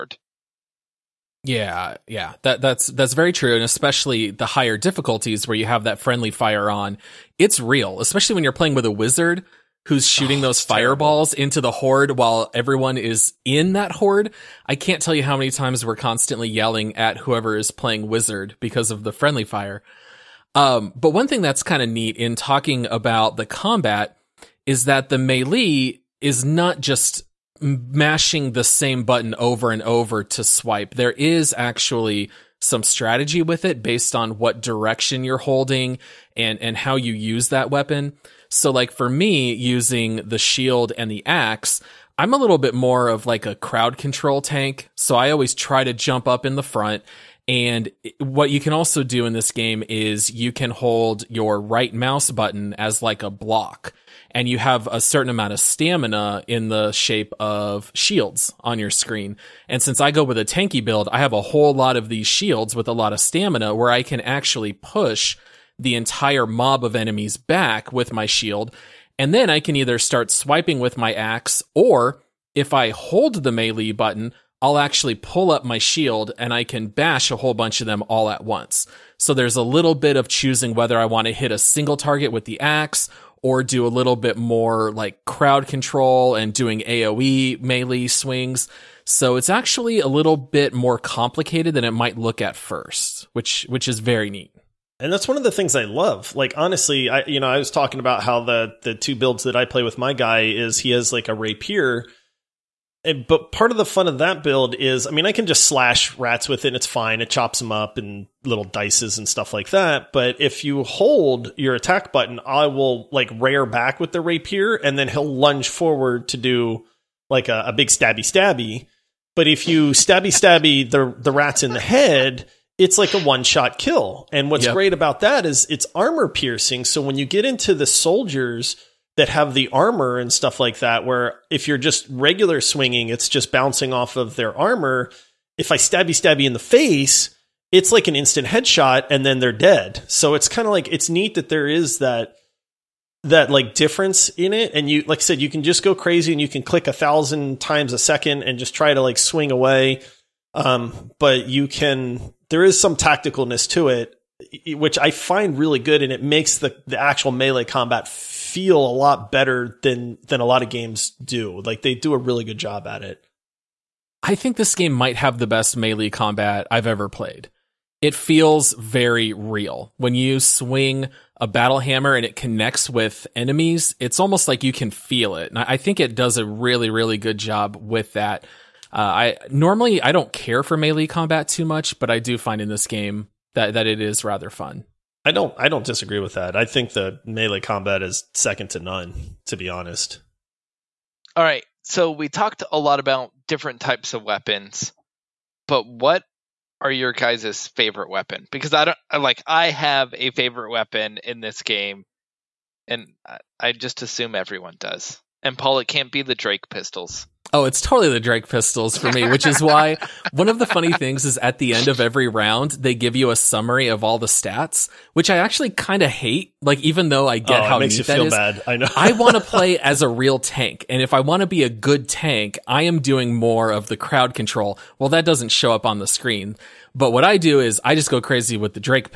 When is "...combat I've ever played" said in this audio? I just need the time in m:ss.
2:46.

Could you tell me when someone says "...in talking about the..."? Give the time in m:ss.
0:22.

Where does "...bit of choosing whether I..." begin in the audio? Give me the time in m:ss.
1:19.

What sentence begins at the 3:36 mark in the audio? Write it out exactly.
Like, even though I get oh, how makes neat you that feel is, bad.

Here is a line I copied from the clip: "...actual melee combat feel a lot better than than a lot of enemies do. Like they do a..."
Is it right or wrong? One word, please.
wrong.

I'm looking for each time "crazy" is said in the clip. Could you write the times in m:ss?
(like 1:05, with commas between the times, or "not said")
2:25, 3:48.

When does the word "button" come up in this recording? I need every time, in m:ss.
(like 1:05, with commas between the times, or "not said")
0:29, 0:52, 1:13, 1:52.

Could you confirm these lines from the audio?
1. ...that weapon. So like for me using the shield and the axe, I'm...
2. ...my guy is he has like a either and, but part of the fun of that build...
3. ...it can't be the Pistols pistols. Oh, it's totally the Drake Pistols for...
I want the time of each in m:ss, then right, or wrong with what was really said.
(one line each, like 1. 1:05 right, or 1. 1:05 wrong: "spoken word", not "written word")
1. 0:37 right
2. 1:39 wrong: "rapier", not "either"
3. 3:25 wrong: "Drake", not "Pistols".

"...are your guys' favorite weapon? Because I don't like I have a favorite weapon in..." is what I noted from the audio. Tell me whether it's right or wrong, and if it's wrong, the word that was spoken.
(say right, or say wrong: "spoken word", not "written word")
right.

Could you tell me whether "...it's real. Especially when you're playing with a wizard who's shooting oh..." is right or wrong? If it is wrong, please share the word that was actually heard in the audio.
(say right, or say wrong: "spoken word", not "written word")
right.